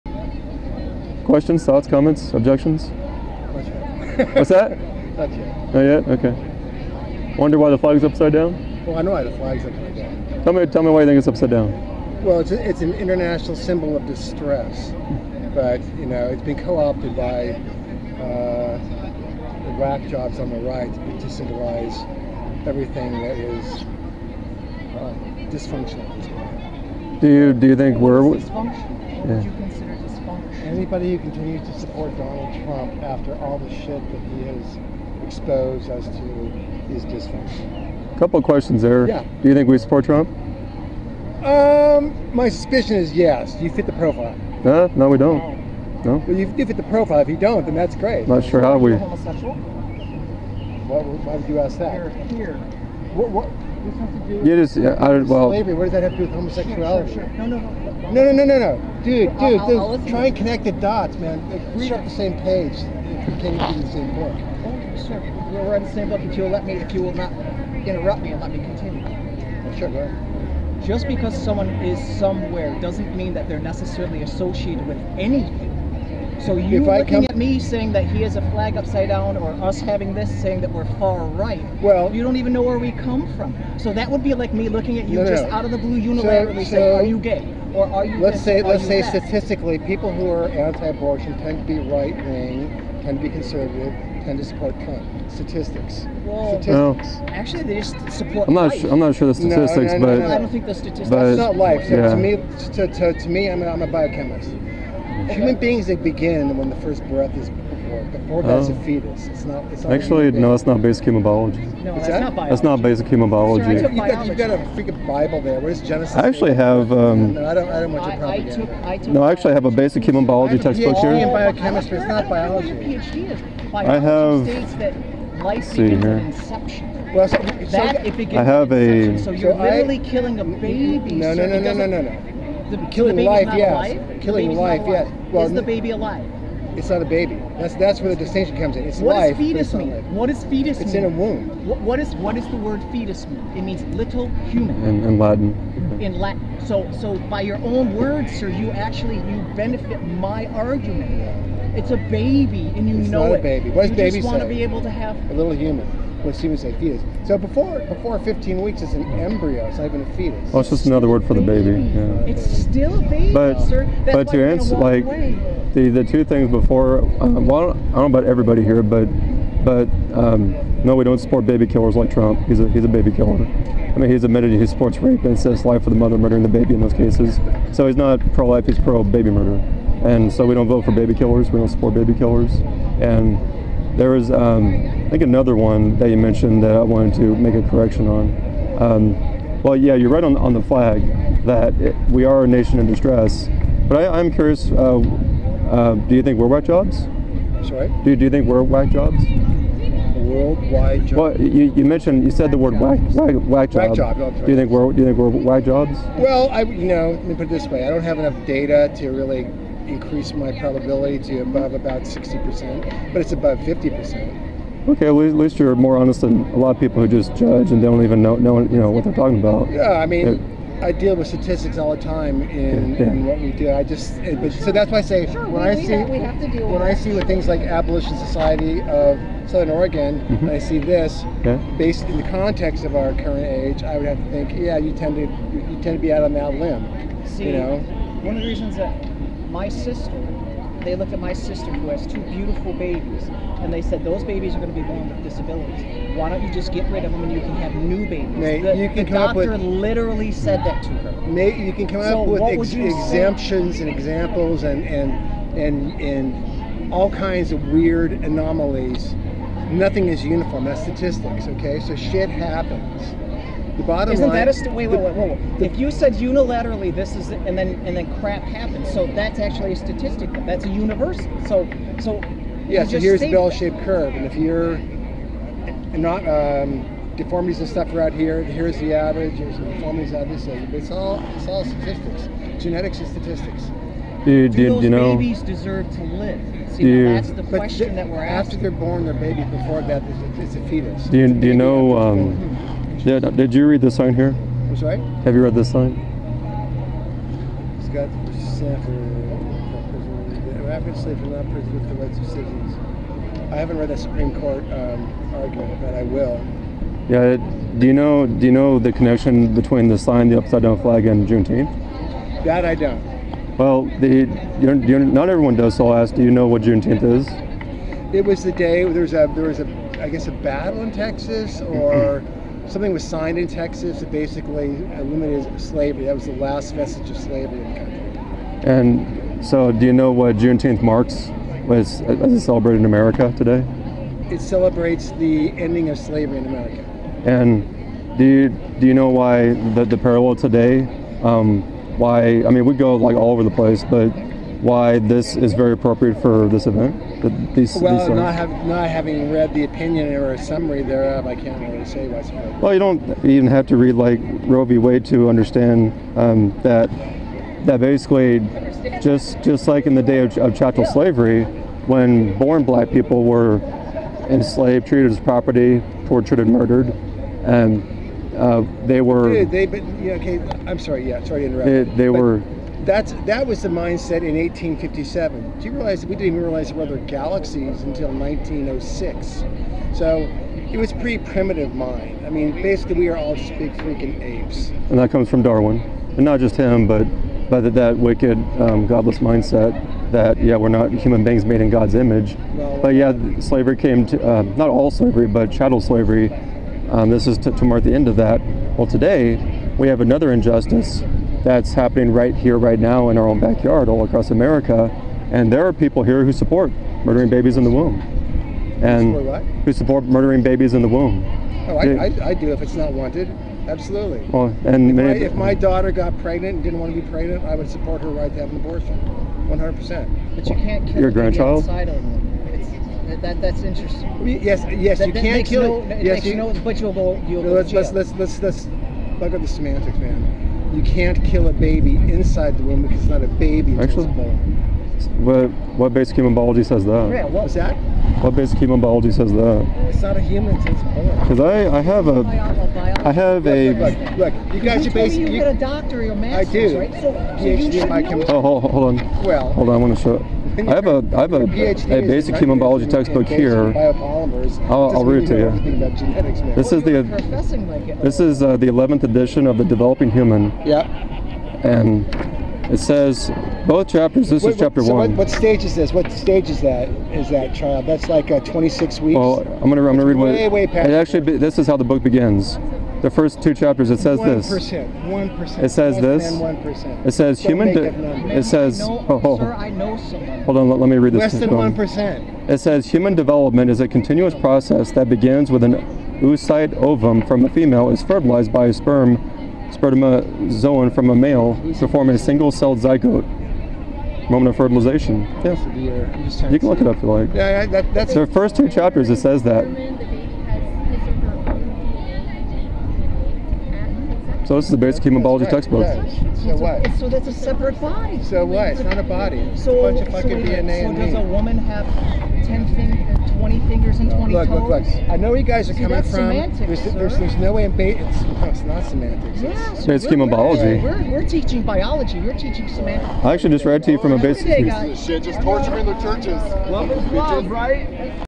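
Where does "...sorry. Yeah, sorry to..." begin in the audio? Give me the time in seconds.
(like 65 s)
370 s.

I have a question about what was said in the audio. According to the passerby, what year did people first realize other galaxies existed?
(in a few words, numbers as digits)
1906.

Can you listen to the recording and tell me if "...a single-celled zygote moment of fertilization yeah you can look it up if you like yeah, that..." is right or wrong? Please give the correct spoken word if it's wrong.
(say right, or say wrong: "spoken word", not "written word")
right.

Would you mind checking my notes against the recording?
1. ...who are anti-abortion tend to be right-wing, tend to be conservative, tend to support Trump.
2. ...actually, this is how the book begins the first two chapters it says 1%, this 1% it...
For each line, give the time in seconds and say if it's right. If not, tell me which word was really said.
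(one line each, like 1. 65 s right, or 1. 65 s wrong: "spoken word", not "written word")
1. 90 s right
2. 470 s right.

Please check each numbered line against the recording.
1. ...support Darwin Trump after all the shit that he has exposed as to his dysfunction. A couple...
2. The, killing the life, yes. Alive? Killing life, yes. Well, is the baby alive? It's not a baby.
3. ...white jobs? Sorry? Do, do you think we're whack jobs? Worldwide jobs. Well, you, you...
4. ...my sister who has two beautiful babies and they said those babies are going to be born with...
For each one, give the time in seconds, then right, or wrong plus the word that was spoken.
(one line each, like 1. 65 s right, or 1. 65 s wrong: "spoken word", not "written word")
1. 31 s wrong: "Donald", not "Darwin"
2. 132 s right
3. 196 s right
4. 241 s right.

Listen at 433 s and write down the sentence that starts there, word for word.
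Actually, what, what basic human biology says that?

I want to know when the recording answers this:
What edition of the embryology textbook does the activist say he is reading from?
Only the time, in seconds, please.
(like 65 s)
458 s.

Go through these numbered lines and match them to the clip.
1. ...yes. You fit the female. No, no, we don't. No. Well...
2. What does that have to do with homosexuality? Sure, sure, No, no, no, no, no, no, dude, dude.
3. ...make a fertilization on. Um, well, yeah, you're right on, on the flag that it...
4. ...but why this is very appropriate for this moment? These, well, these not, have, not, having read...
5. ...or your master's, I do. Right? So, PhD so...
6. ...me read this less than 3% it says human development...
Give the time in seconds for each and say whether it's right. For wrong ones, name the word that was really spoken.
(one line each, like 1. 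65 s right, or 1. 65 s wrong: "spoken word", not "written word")
1. 43 s wrong: "profile", not "female"
2. 55 s right
3. 187 s wrong: "correction", not "fertilization"
4. 343 s wrong: "event", not "moment"
5. 445 s right
6. 480 s wrong: "1", not "3".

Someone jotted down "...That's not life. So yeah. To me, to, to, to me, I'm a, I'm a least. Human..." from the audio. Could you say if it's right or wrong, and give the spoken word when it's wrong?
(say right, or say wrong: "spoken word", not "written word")
wrong: "biochemist", not "least".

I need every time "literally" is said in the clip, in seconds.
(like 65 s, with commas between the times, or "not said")
129 s, 249 s.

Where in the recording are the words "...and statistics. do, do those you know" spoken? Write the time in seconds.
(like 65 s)
282 s.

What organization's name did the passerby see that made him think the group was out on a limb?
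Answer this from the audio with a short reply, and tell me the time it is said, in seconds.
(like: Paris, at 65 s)
Abolition Society of Southern Oregon, at 227 s.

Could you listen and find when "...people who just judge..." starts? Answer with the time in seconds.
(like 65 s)
216 s.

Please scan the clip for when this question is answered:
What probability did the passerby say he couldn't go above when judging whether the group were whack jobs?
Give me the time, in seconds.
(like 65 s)
212 s.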